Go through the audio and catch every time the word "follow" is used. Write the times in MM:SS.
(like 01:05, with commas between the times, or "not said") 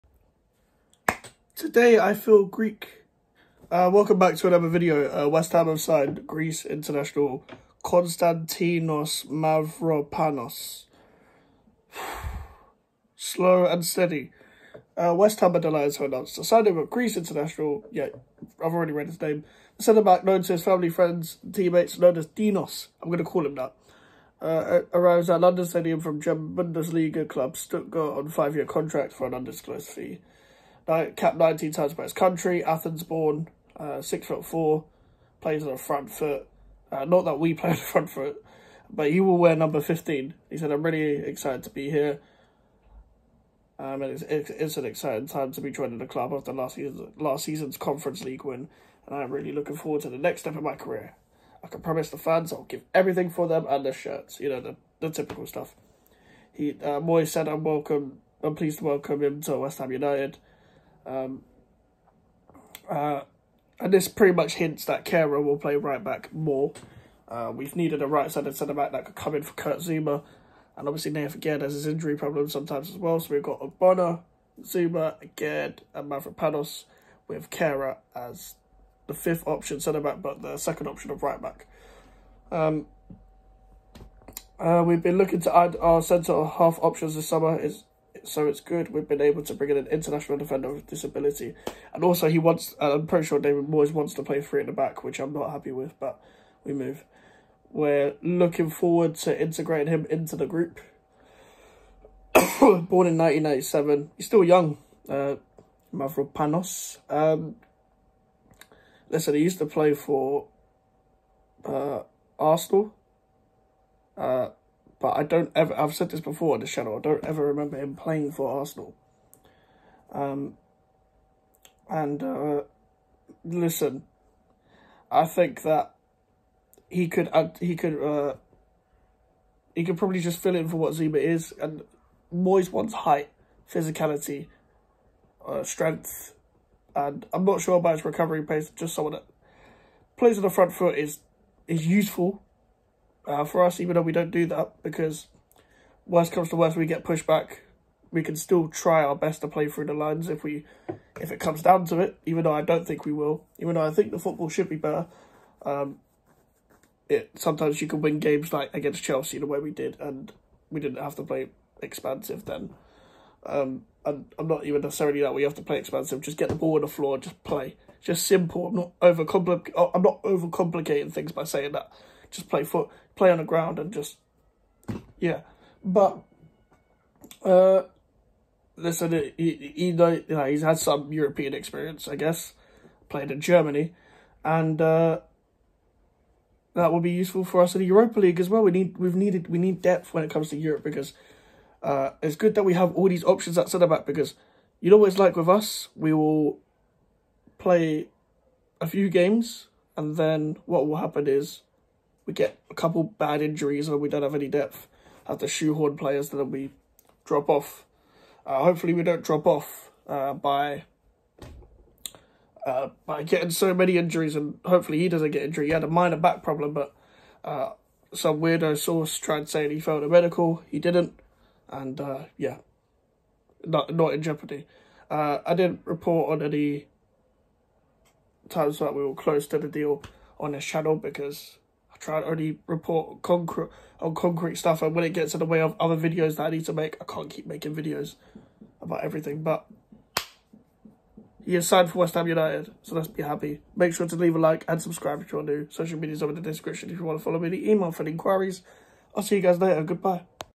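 04:07.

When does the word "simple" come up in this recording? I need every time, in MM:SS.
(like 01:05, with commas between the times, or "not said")
02:48.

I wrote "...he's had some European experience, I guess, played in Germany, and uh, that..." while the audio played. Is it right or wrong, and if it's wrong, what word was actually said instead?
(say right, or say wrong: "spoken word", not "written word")
right.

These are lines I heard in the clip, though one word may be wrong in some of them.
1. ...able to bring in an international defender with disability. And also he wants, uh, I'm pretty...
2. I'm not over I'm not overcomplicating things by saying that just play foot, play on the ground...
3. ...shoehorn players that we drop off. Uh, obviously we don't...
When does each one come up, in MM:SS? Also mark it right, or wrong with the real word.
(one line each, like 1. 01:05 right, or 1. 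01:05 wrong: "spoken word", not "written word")
1. 01:29 right
2. 02:48 right
3. 03:25 wrong: "hopefully", not "obviously".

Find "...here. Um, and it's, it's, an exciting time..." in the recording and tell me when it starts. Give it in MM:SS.
00:41.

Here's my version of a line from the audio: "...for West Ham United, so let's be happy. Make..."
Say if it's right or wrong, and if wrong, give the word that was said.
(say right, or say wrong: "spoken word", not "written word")
right.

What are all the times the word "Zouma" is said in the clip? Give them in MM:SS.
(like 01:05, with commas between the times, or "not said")
01:09, 01:14, 02:10.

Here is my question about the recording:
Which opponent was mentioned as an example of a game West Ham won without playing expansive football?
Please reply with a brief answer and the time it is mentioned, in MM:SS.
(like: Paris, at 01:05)
Chelsea, at 02:39.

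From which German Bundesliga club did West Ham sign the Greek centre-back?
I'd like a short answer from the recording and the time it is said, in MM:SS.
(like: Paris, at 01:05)
Stuttgart, at 00:27.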